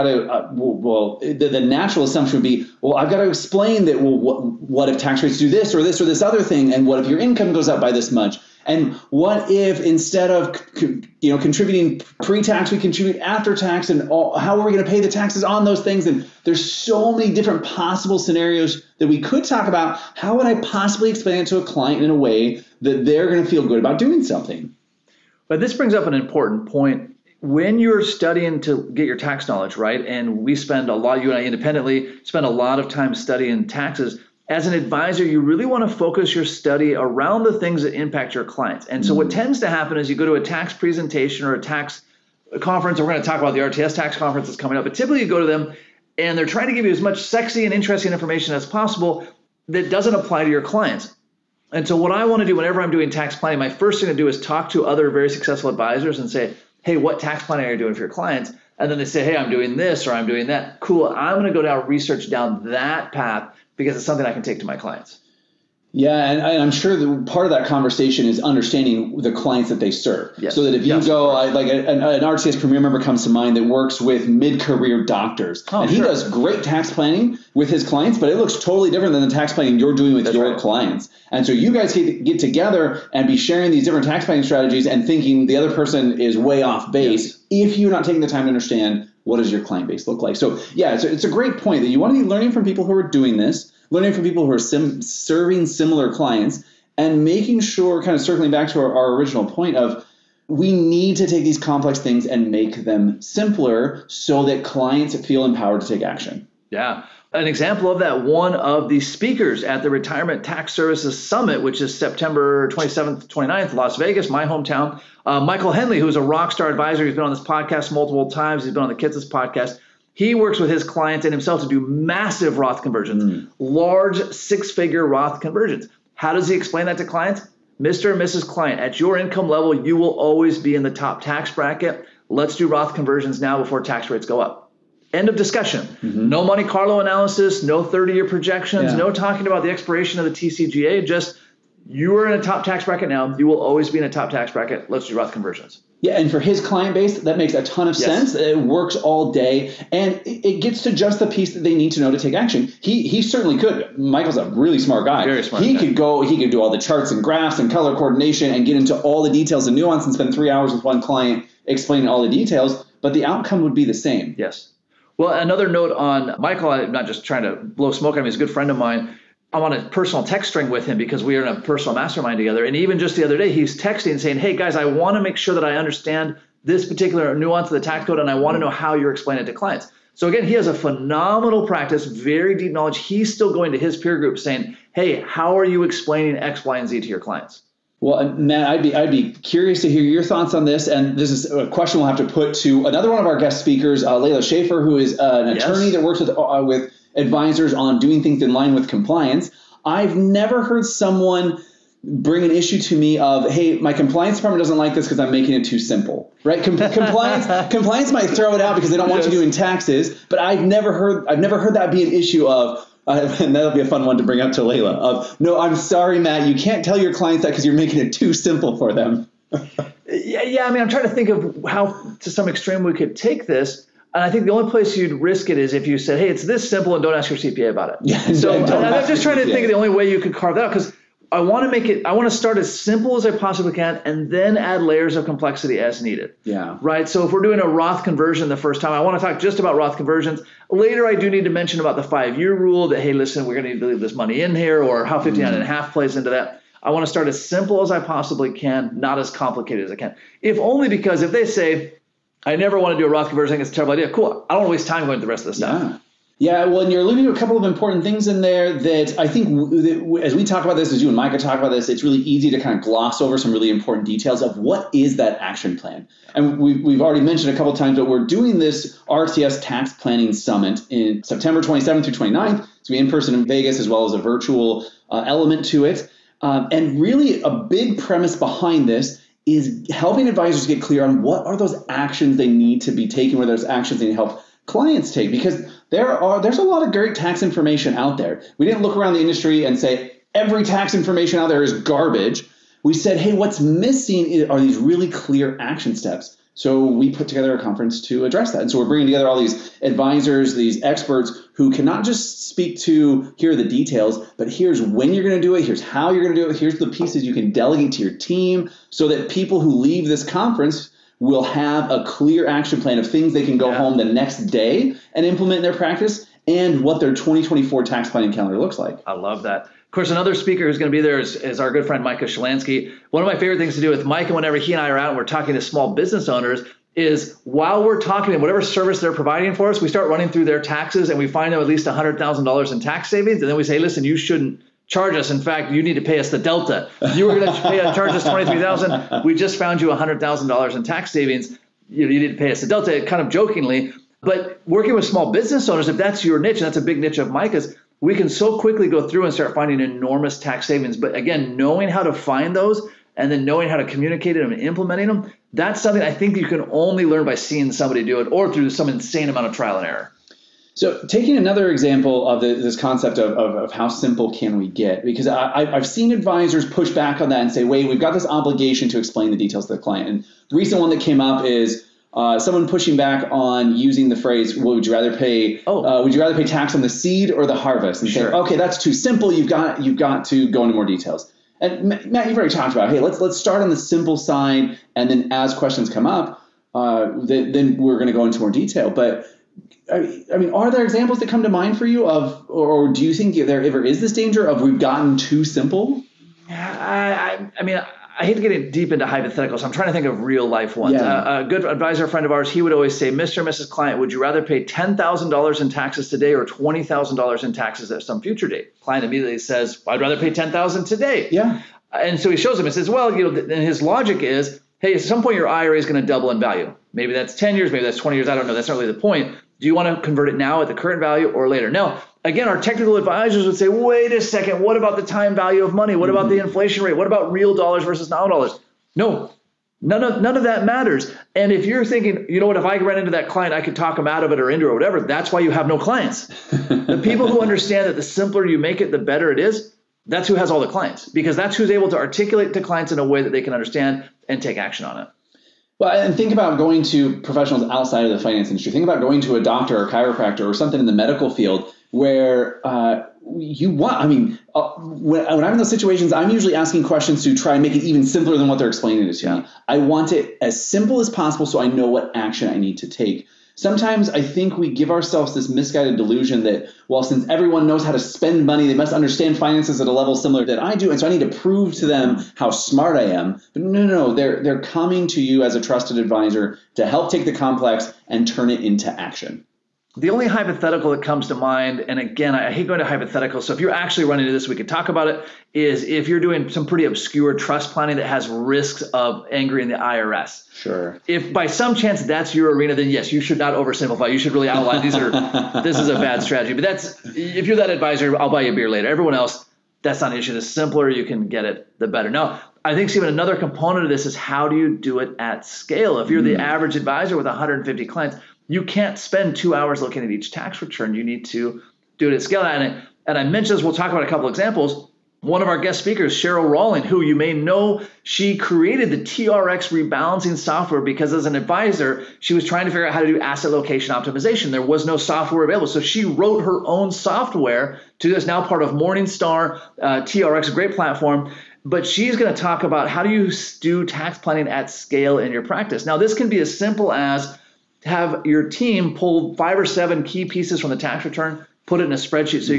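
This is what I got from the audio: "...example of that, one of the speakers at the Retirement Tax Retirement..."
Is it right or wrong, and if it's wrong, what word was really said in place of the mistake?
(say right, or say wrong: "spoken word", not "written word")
wrong: "Services", not "Retirement".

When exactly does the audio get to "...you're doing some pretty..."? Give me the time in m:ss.
8:06.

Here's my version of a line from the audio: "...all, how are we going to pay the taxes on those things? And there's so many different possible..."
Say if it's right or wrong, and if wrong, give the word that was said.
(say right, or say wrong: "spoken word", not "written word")
right.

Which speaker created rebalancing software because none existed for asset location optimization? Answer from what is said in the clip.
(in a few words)
Sheryl Rowling.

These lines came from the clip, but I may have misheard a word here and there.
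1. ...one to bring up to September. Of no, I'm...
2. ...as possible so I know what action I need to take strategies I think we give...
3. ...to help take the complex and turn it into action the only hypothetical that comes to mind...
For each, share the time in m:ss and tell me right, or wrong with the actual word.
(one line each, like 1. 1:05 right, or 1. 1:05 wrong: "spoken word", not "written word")
1. 3:34 wrong: "Layla", not "September"
2. 7:40 wrong: "sometimes", not "strategies"
3. 7:56 right.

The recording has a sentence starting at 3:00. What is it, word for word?
So again, he has a phenomenal practice, very deep knowledge.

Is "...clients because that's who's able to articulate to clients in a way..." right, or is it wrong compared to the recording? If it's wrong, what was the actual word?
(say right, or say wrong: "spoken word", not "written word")
right.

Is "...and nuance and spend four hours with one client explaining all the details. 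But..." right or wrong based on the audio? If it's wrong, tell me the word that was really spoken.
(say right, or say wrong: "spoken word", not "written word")
wrong: "three", not "four".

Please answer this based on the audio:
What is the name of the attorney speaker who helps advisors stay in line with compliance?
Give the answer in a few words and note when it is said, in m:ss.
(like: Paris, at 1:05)
Layla Schaefer, at 3:14.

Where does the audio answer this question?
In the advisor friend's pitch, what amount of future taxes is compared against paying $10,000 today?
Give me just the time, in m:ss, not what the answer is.
6:46.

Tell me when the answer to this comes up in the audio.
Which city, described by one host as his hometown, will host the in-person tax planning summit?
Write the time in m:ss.
1:53.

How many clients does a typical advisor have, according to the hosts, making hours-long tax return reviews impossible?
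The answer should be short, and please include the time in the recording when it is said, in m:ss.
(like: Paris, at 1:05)
150, at 8:27.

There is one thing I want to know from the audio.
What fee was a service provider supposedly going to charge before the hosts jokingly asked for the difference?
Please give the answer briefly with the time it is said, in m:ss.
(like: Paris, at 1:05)
23,000, at 5:38.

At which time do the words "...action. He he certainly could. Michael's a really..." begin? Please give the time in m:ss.
2:32.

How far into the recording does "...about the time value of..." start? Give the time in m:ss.
7:04.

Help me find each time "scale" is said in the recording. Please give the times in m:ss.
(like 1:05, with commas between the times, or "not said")
8:25, 8:32, 8:54.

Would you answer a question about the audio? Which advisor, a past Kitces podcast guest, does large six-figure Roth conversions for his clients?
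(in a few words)
Michael Henley.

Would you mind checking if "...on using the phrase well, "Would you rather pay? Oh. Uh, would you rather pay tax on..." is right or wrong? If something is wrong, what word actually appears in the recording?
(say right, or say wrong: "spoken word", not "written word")
right.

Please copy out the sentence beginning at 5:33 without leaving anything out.
And then we say, listen, you shouldn't charge us.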